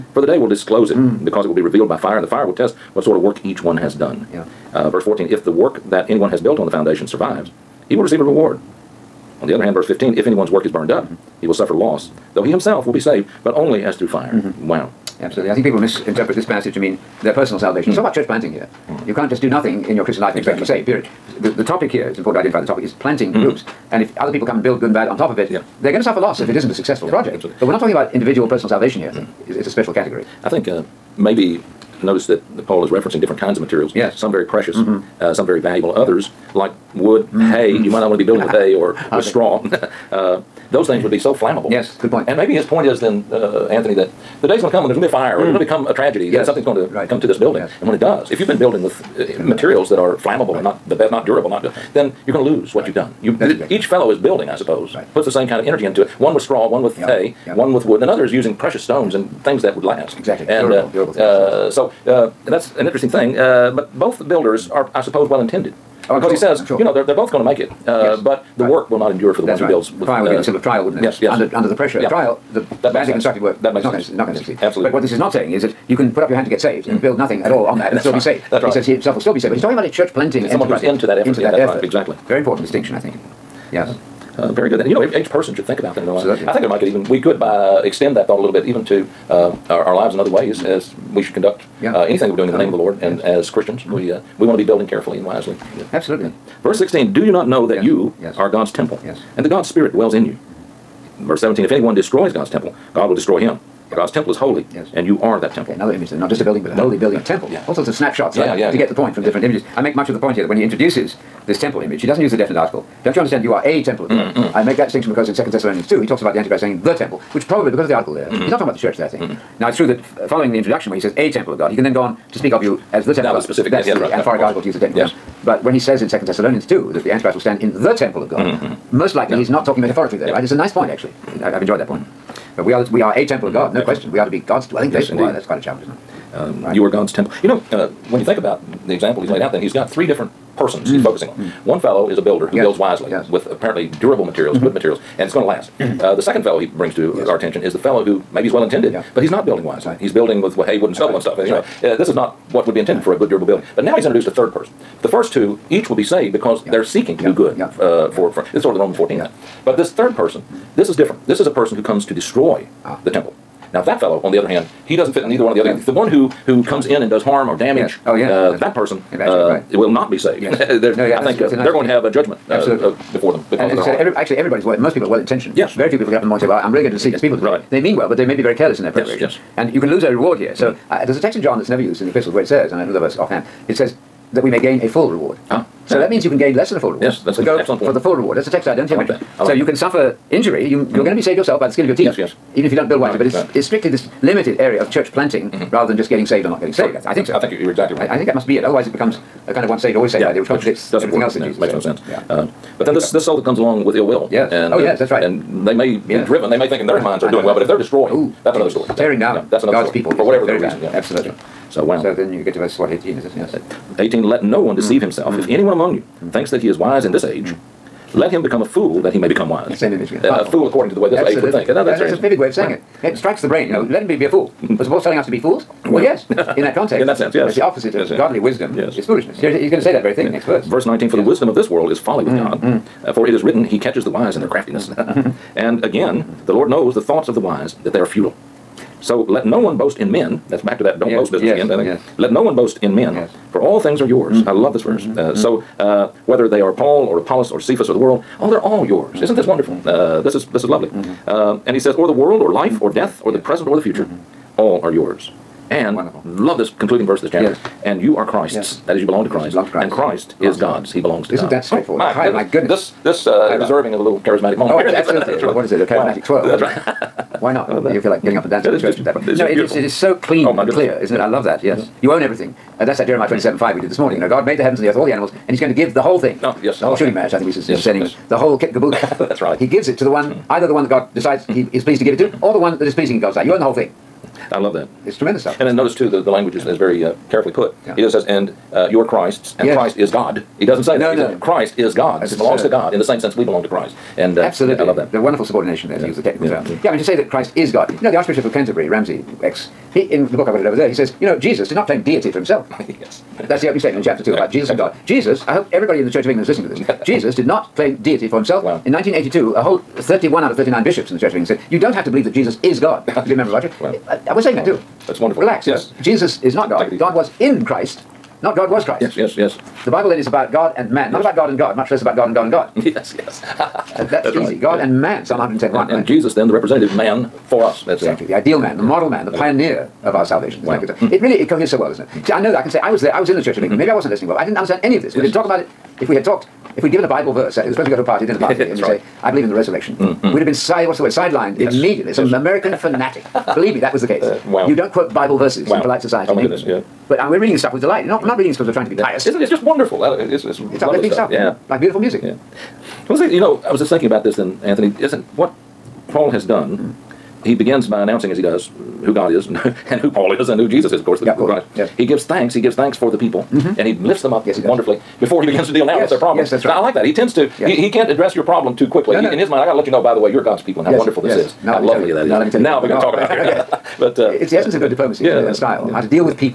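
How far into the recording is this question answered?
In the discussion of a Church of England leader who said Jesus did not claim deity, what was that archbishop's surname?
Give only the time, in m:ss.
4:58.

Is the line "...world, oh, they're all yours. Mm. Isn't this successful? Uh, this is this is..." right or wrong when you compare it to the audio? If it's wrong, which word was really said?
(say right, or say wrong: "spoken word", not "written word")
wrong: "wonderful", not "successful".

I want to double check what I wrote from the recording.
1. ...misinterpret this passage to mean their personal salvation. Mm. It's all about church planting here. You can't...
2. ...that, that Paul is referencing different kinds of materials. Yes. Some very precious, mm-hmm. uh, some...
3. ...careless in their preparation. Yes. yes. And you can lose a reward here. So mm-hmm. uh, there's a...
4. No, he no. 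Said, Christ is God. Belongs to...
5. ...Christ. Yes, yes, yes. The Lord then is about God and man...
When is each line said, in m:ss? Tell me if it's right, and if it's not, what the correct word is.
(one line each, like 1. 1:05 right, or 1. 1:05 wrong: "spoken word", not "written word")
1. 0:15 right
2. 0:32 right
3. 2:58 right
4. 4:50 right
5. 5:18 wrong: "Bible", not "Lord".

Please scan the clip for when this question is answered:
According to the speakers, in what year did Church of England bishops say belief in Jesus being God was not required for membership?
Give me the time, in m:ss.
5:08.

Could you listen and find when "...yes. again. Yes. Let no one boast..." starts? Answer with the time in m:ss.
4:01.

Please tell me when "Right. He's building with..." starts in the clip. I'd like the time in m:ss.
2:29.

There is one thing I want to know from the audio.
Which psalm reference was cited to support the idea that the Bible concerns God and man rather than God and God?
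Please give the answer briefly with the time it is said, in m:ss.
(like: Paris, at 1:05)
Psalm 110:1, at 5:25.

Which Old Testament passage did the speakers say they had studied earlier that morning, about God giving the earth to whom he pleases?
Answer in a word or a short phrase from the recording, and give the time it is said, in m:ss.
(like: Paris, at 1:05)
Jeremiah 27:5, at 4:33.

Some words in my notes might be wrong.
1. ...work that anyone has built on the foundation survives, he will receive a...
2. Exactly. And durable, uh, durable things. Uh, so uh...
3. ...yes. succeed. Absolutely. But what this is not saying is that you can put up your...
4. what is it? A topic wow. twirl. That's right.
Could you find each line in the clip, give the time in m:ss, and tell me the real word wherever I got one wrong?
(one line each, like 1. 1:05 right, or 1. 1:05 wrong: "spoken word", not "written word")
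1. 0:05 right
2. 1:00 right
3. 1:14 right
4. 4:25 wrong: "charismatic", not "topic".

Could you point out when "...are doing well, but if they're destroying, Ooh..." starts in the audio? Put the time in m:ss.
3:27.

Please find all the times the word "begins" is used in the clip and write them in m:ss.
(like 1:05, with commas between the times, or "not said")
5:57, 6:05.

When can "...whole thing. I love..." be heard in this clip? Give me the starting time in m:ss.
4:43.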